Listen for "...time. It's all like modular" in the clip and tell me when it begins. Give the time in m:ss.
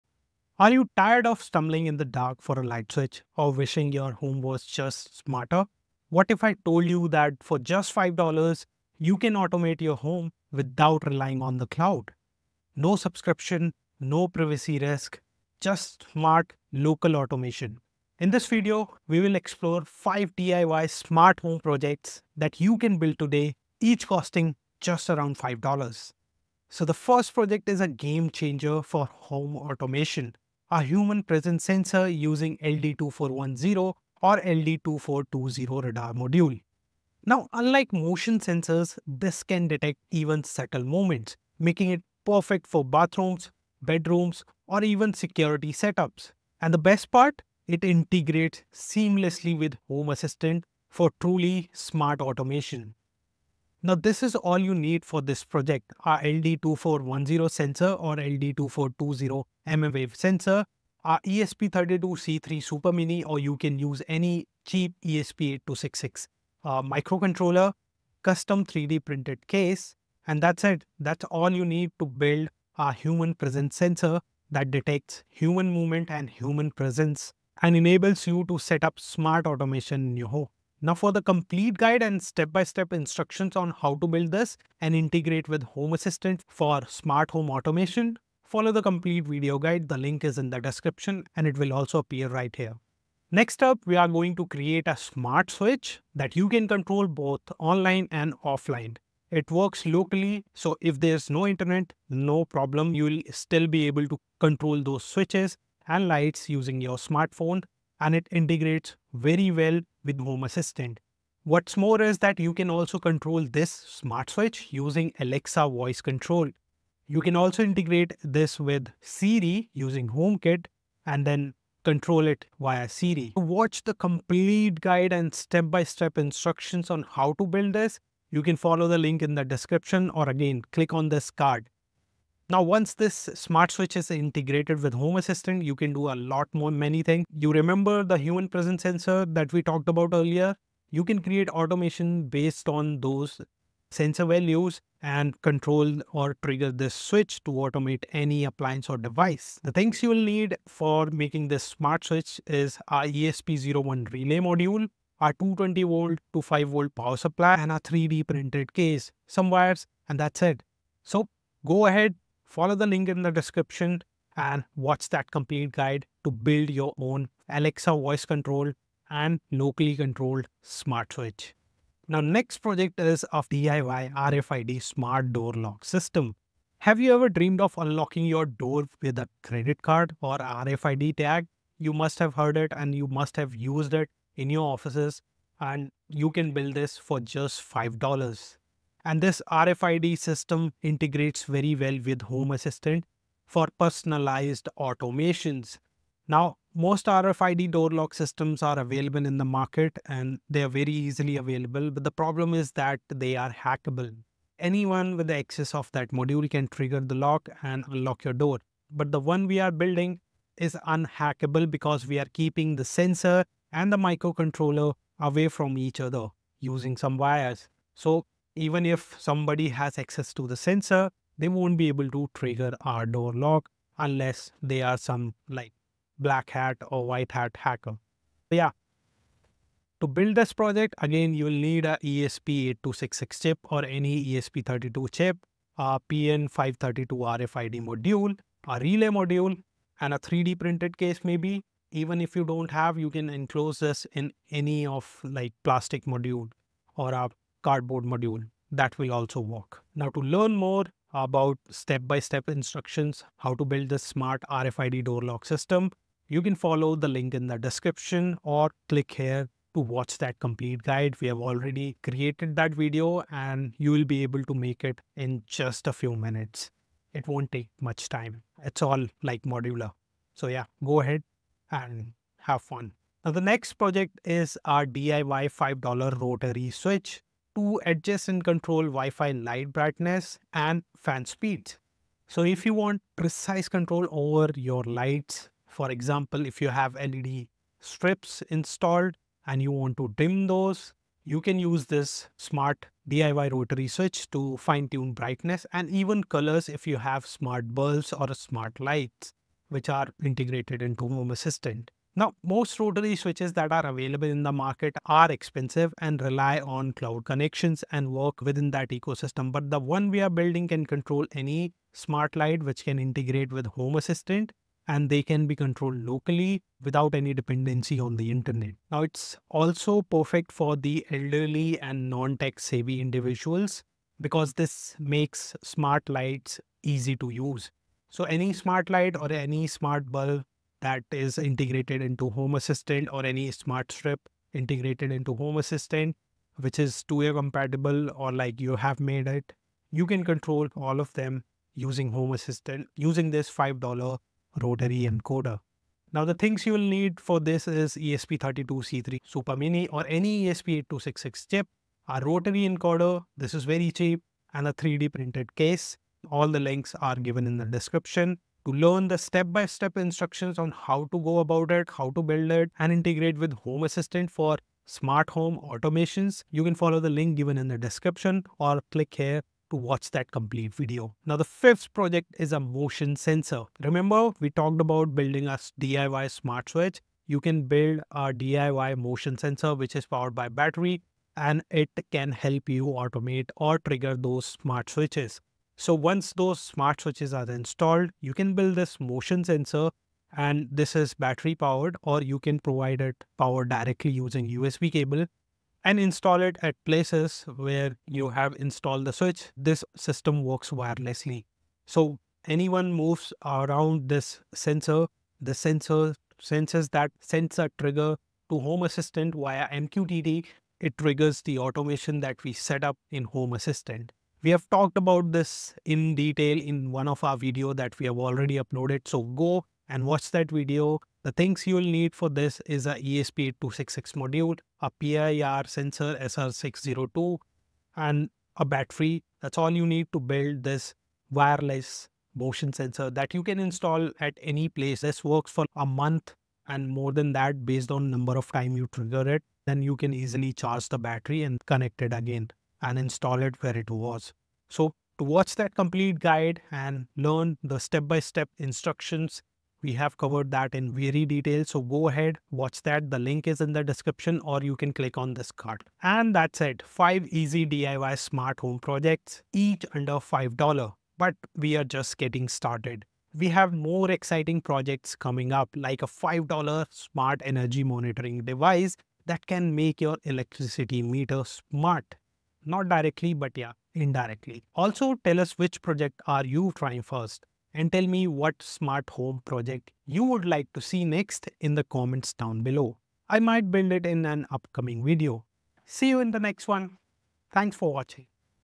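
4:28.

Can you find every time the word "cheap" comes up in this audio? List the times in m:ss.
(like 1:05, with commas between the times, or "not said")
1:04, 5:53.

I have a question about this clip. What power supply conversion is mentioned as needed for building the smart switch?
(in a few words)
220 volt to 5 volt.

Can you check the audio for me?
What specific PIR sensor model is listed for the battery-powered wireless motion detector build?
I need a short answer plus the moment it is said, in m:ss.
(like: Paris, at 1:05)
SR602, at 7:06.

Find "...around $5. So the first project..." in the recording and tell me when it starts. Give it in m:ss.
0:25.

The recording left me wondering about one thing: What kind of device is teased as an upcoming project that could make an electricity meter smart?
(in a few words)
smart energy monitoring device.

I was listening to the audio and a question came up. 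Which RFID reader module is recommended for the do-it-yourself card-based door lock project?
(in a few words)
PN532.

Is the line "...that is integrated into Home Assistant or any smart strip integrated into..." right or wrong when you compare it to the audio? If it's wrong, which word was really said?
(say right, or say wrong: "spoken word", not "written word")
right.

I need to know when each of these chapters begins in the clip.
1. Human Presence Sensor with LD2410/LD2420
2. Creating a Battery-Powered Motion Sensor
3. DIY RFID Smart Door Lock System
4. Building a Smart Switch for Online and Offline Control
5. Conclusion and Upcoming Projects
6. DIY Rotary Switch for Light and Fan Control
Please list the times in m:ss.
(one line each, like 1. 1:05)
1. 0:26
2. 6:11
3. 2:51
4. 1:33
5. 7:36
6. 4:33.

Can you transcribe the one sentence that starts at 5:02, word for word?
Now, most rotary switches that are available in the market are expensive and rely on cloud connections and work within that ecosystem.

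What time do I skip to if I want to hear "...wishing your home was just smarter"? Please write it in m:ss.
0:03.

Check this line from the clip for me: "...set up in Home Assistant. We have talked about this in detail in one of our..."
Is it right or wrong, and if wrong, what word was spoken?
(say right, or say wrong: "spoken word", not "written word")
right.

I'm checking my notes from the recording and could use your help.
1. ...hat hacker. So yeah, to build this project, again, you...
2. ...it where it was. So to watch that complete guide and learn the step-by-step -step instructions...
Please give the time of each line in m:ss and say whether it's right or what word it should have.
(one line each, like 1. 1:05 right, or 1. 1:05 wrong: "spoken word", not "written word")
1. 3:47 right
2. 7:23 right.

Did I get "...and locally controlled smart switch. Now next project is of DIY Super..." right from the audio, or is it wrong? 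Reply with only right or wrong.
wrong.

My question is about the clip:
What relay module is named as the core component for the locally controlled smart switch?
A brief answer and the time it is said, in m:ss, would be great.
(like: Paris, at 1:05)
ESP01 relay module, at 2:33.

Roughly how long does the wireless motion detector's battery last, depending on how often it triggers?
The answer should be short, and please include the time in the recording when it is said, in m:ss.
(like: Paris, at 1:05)
a month, at 7:15.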